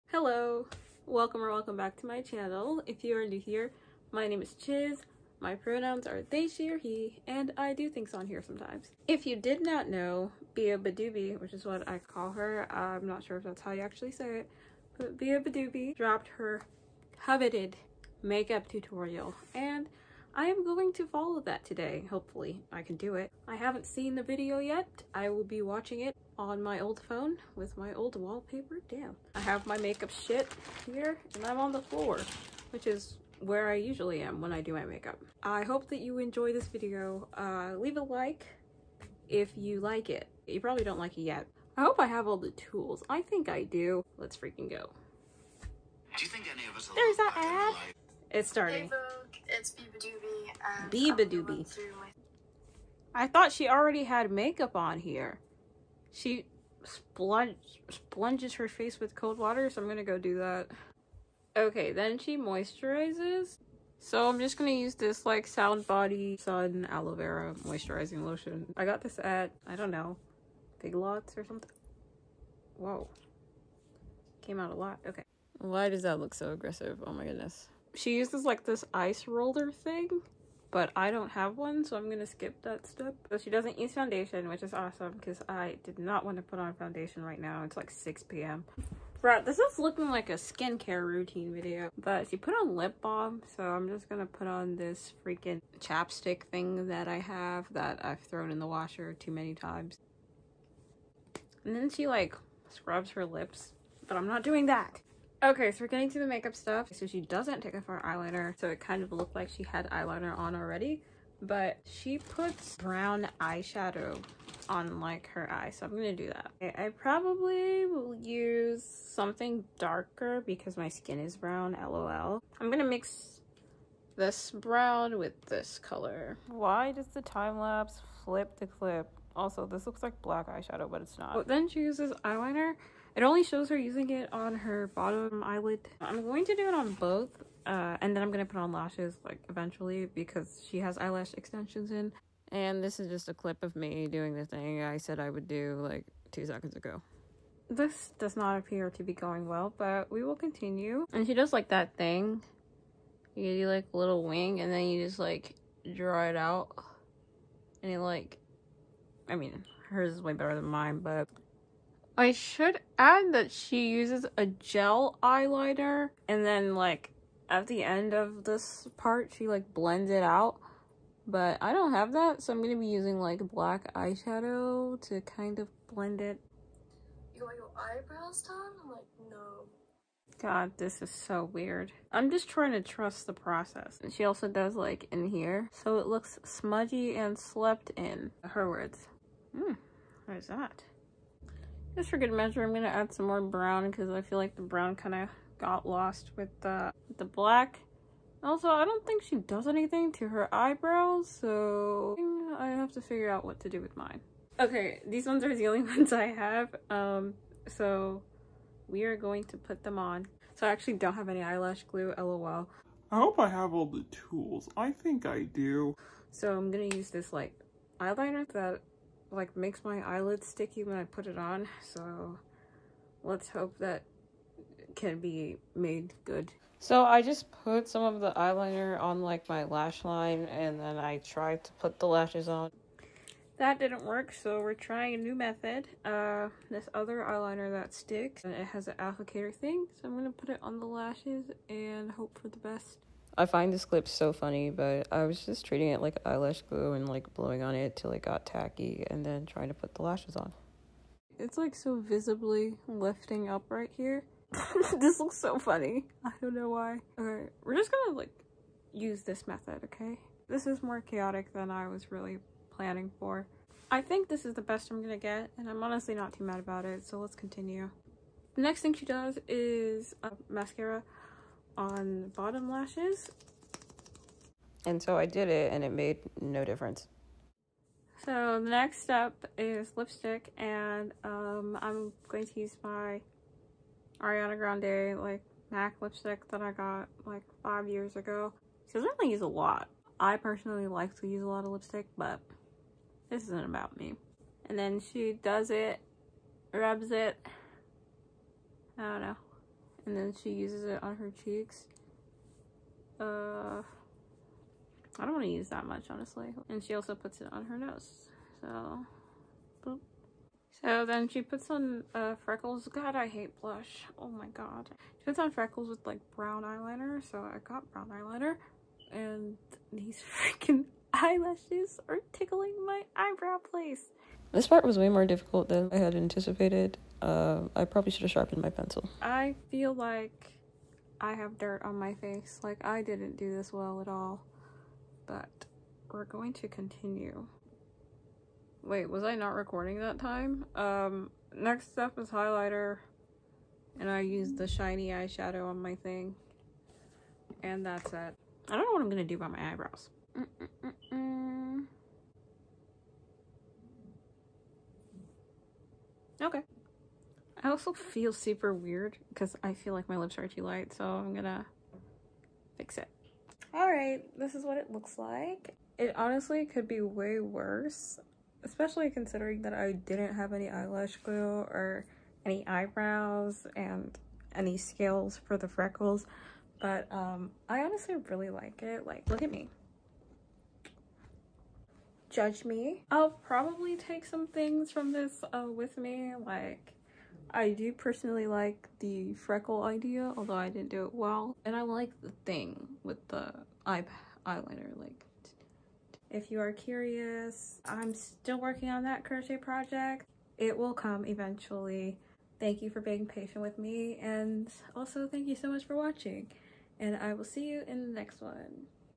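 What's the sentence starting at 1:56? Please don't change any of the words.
I, I probably will use something darker because my skin is brown, lol.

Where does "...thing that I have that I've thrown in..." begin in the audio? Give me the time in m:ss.
1:36.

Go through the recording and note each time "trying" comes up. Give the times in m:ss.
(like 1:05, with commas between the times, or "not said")
3:02, 3:54, 4:09.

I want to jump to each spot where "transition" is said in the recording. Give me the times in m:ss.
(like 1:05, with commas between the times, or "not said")
not said.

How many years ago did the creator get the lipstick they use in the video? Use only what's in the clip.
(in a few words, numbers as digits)
5.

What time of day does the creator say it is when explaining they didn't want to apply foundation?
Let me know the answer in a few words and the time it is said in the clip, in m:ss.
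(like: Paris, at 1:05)
6 p.m., at 1:27.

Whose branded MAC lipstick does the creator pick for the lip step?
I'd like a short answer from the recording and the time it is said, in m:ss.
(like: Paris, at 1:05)
Ariana Grande, at 4:44.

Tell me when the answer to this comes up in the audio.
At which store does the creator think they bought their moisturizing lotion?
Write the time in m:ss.
1:10.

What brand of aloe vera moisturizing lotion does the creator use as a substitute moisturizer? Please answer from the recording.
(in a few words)
Sound Body.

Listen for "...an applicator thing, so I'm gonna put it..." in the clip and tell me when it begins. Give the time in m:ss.
3:58.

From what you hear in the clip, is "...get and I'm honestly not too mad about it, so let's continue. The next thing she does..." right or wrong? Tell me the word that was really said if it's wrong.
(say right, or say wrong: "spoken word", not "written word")
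right.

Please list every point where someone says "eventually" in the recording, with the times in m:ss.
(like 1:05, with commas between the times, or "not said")
2:19, 6:41.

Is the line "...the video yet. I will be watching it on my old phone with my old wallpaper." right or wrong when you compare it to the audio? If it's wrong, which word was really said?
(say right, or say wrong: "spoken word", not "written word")
right.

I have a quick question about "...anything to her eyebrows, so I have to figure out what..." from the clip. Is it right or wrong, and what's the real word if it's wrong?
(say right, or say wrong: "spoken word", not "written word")
right.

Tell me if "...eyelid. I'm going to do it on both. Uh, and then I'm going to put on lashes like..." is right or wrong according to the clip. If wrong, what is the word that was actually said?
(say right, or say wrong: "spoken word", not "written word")
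right.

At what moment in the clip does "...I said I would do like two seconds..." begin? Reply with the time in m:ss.
2:24.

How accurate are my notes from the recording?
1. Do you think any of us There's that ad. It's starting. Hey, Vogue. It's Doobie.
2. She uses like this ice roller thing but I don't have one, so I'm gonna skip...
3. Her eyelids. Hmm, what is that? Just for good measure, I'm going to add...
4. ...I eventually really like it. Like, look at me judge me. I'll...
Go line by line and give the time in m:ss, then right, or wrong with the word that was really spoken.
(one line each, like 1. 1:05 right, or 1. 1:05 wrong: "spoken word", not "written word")
1. 0:46 right
2. 1:17 right
3. 3:08 wrong: "words", not "eyelids"
4. 6:17 wrong: "honestly", not "eventually".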